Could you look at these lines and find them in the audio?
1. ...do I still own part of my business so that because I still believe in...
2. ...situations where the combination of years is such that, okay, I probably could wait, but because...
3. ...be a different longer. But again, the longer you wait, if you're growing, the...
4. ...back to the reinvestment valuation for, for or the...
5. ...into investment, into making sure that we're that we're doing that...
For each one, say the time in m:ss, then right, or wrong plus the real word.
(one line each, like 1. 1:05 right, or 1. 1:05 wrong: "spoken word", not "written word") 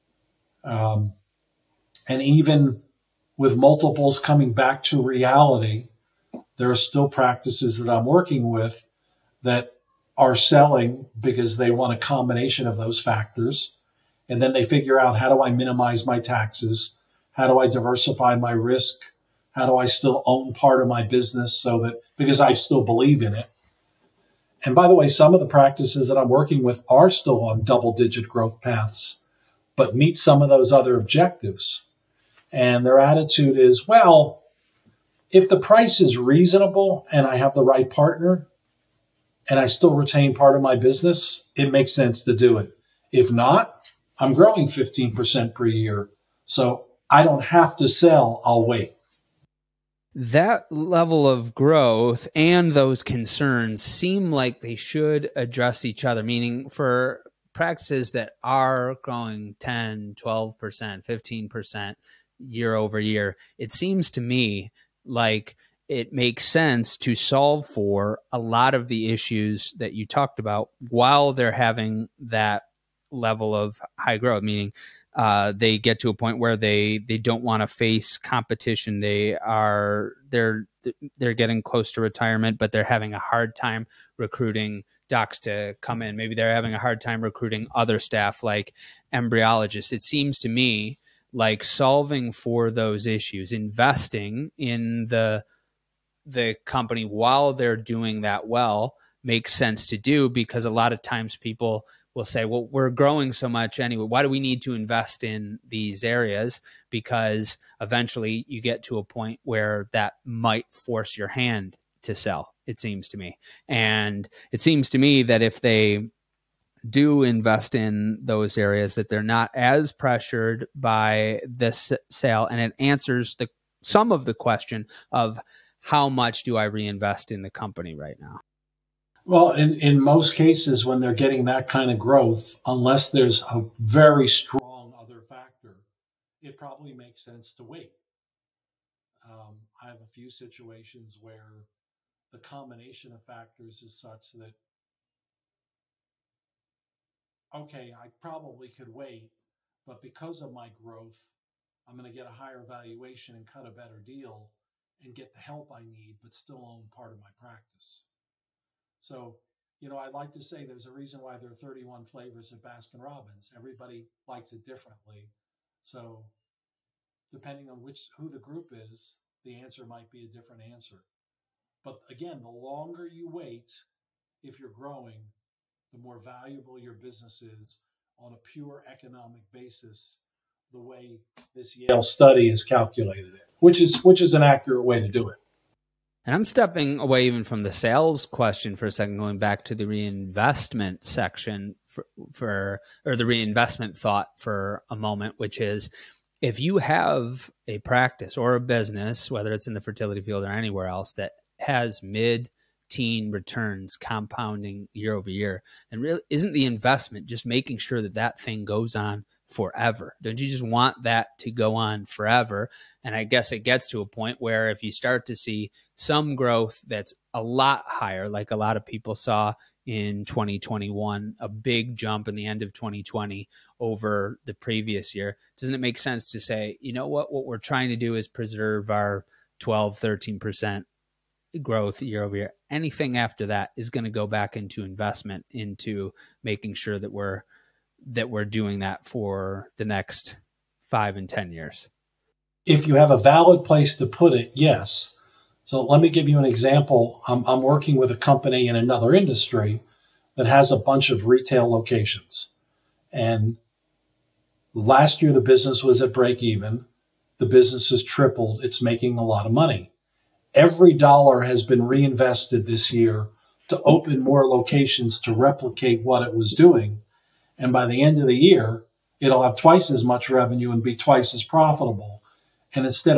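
1. 0:19 right
2. 2:20 wrong: "factors", not "years"
3. 2:50 wrong: "answer", not "longer"
4. 3:09 wrong: "section", not "valuation"
5. 3:54 right.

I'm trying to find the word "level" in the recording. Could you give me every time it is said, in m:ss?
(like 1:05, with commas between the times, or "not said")
0:50, 1:13.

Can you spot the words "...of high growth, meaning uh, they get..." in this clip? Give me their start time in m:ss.
1:13.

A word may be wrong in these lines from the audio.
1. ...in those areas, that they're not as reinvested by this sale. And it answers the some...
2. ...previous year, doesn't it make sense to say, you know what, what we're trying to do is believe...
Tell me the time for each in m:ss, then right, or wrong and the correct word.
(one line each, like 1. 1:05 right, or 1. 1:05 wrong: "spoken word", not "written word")
1. 1:57 wrong: "pressured", not "reinvested"
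2. 3:44 wrong: "preserve", not "believe".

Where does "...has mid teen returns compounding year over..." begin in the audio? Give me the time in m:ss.
3:21.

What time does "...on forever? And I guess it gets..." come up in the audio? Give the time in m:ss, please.
3:31.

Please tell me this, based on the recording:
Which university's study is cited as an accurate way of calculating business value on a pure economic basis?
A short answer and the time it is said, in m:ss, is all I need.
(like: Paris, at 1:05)
Yale, at 3:01.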